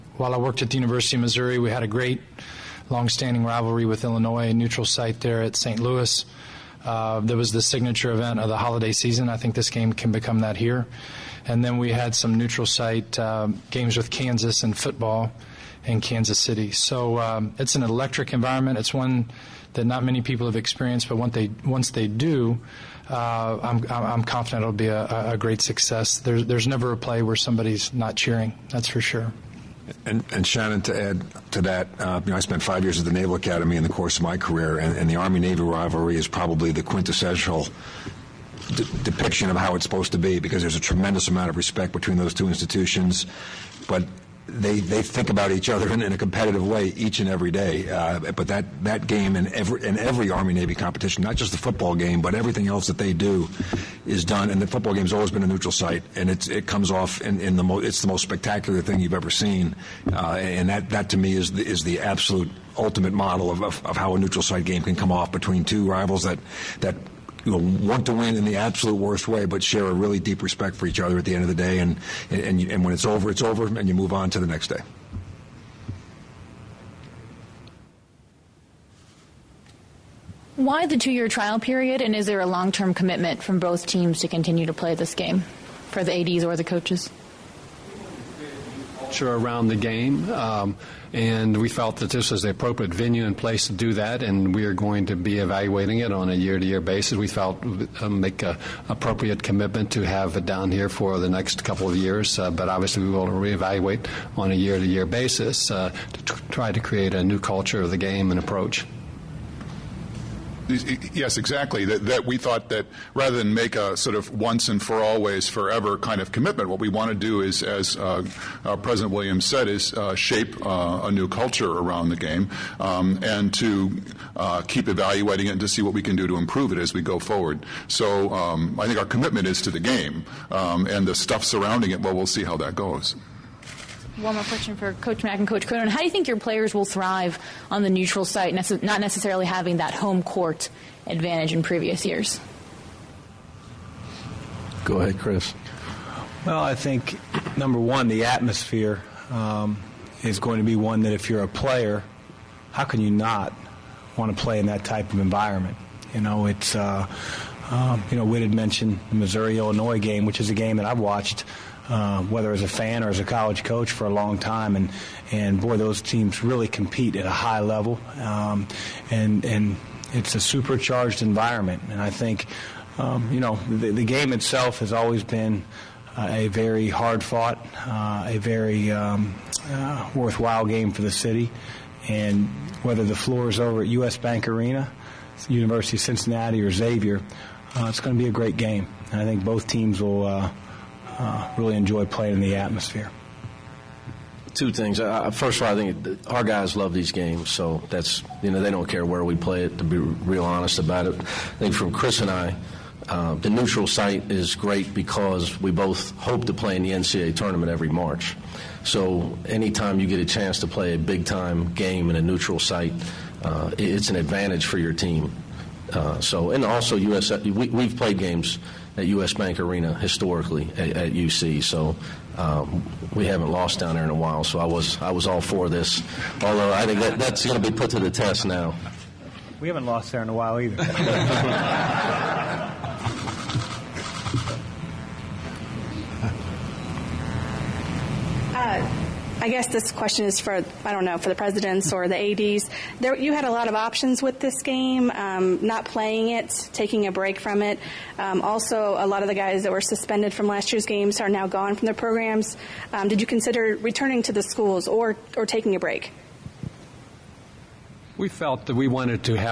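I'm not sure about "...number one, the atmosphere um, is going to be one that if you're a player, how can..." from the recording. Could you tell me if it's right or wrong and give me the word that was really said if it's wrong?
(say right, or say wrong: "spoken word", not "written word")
right.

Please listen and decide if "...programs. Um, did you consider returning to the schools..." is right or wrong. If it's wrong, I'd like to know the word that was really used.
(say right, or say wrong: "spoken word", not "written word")
right.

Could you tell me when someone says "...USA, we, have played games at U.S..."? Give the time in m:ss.
3:36.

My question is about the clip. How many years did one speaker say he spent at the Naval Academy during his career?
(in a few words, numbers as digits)
5.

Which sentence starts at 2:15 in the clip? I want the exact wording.
How do you think your players will thrive on the neutral site, not necessarily having that home court advantage in previous years?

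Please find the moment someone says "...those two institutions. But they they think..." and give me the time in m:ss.
0:42.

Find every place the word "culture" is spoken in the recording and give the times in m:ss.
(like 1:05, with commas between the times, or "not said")
1:47, 2:01.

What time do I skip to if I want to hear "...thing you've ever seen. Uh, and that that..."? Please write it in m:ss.
0:58.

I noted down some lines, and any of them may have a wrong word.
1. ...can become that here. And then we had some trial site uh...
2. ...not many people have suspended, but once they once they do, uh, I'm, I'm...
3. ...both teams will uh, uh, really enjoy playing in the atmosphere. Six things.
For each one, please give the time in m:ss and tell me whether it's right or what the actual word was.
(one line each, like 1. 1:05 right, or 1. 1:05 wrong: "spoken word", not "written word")
1. 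0:09 wrong: "neutral", not "trial"
2. 0:19 wrong: "experienced", not "suspended"
3. 3:09 wrong: "Two", not "Six".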